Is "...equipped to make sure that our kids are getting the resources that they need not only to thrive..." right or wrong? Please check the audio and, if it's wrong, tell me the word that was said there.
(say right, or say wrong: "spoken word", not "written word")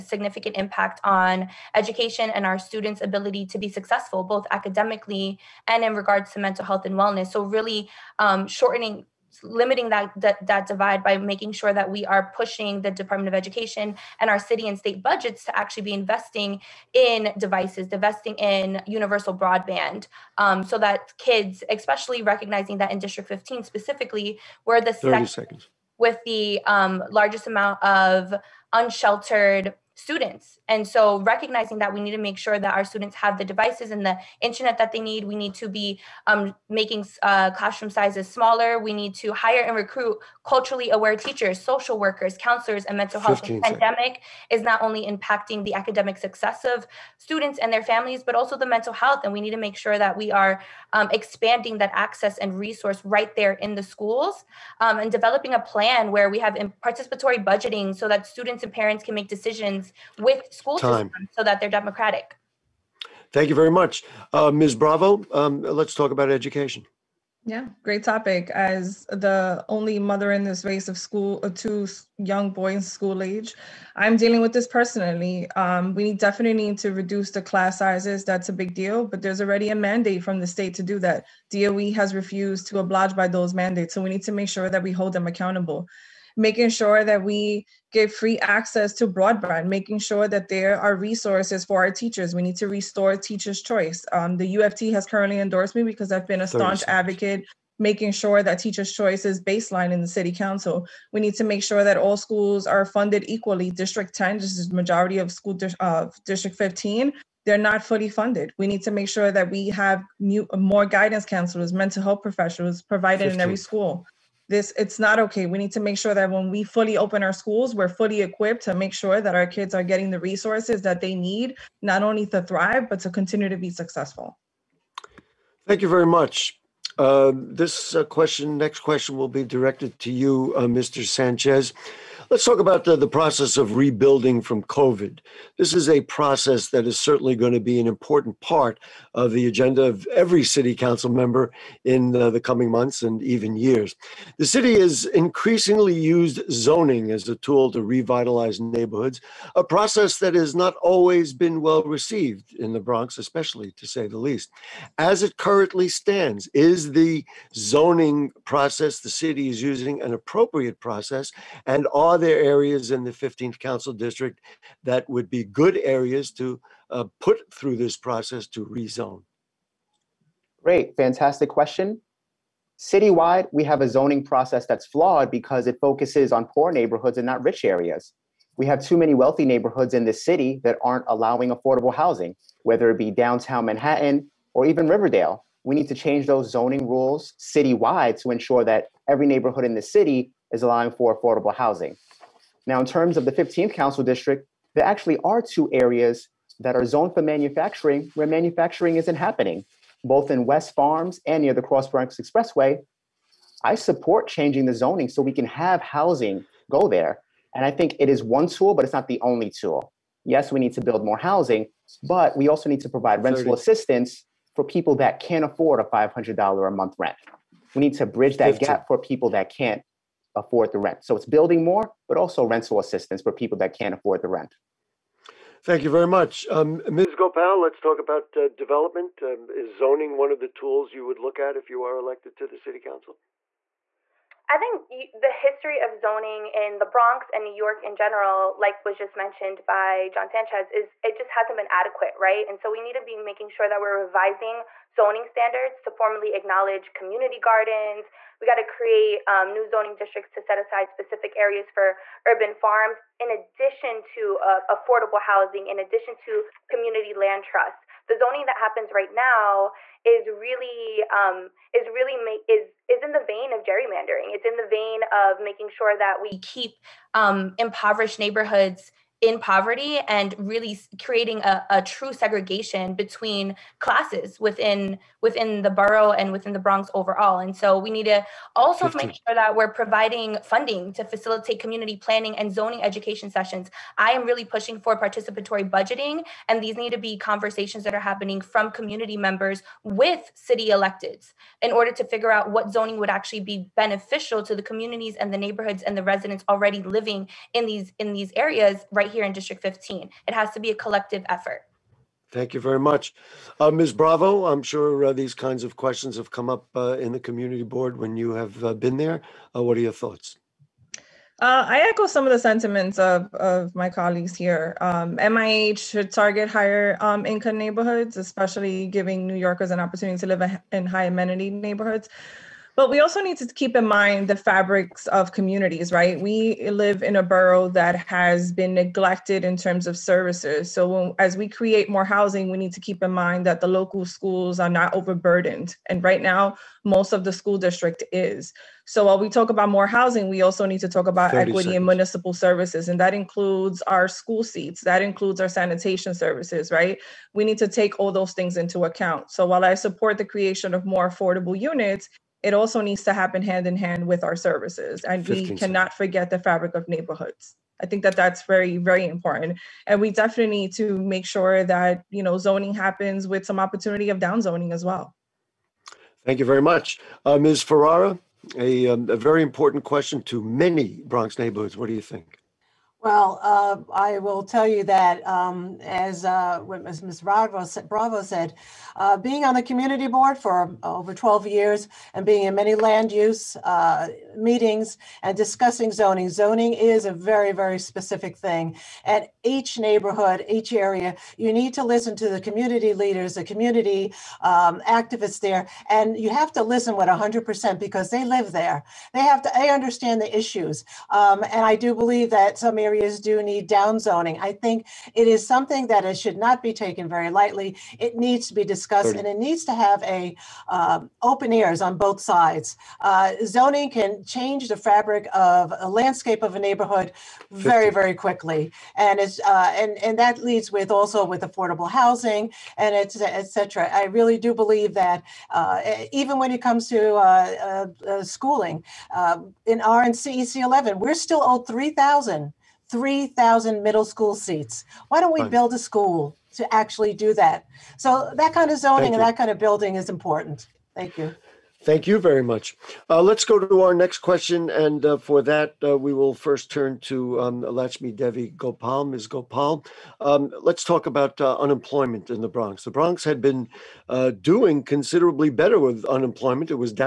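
right.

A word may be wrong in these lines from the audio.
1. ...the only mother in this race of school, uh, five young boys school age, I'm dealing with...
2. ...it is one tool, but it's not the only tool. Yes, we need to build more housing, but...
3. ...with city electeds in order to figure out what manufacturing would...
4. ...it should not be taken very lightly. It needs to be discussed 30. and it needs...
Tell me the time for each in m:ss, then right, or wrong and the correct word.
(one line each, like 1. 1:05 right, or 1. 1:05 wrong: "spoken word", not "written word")
1. 1:09 wrong: "two", not "five"
2. 3:27 right
3. 4:49 wrong: "zoning", not "manufacturing"
4. 6:46 right.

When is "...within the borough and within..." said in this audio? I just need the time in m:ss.
4:35.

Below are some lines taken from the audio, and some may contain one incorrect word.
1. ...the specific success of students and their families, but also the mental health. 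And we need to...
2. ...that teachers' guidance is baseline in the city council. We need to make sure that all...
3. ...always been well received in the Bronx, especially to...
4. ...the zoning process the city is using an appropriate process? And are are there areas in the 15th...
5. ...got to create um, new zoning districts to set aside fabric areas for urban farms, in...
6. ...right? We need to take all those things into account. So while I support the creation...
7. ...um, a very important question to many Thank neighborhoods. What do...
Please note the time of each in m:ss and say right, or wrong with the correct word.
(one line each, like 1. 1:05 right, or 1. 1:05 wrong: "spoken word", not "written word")
1. 0:45 wrong: "academic", not "specific"
2. 1:38 wrong: "choice", not "guidance"
3. 2:30 right
4. 2:36 right
5. 4:08 wrong: "specific", not "fabric"
6. 5:46 right
7. 6:08 wrong: "Bronx", not "Thank".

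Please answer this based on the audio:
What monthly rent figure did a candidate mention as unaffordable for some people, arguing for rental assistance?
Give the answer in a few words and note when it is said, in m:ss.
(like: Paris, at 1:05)
$500, at 3:35.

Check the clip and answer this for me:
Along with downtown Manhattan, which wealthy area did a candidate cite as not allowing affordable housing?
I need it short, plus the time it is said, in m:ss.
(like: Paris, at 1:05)
Riverdale, at 3:04.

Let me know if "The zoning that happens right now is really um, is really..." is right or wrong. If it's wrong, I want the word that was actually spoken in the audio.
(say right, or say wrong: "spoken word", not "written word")
right.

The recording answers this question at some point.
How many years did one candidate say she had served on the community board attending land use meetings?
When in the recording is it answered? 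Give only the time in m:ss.
6:20.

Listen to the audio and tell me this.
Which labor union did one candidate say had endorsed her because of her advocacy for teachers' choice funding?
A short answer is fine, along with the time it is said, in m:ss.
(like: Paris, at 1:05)
UFT, at 1:34.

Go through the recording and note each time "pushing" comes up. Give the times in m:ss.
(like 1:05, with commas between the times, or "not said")
0:12, 4:44.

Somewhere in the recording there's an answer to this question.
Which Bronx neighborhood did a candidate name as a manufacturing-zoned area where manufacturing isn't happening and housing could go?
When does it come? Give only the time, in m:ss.
3:20.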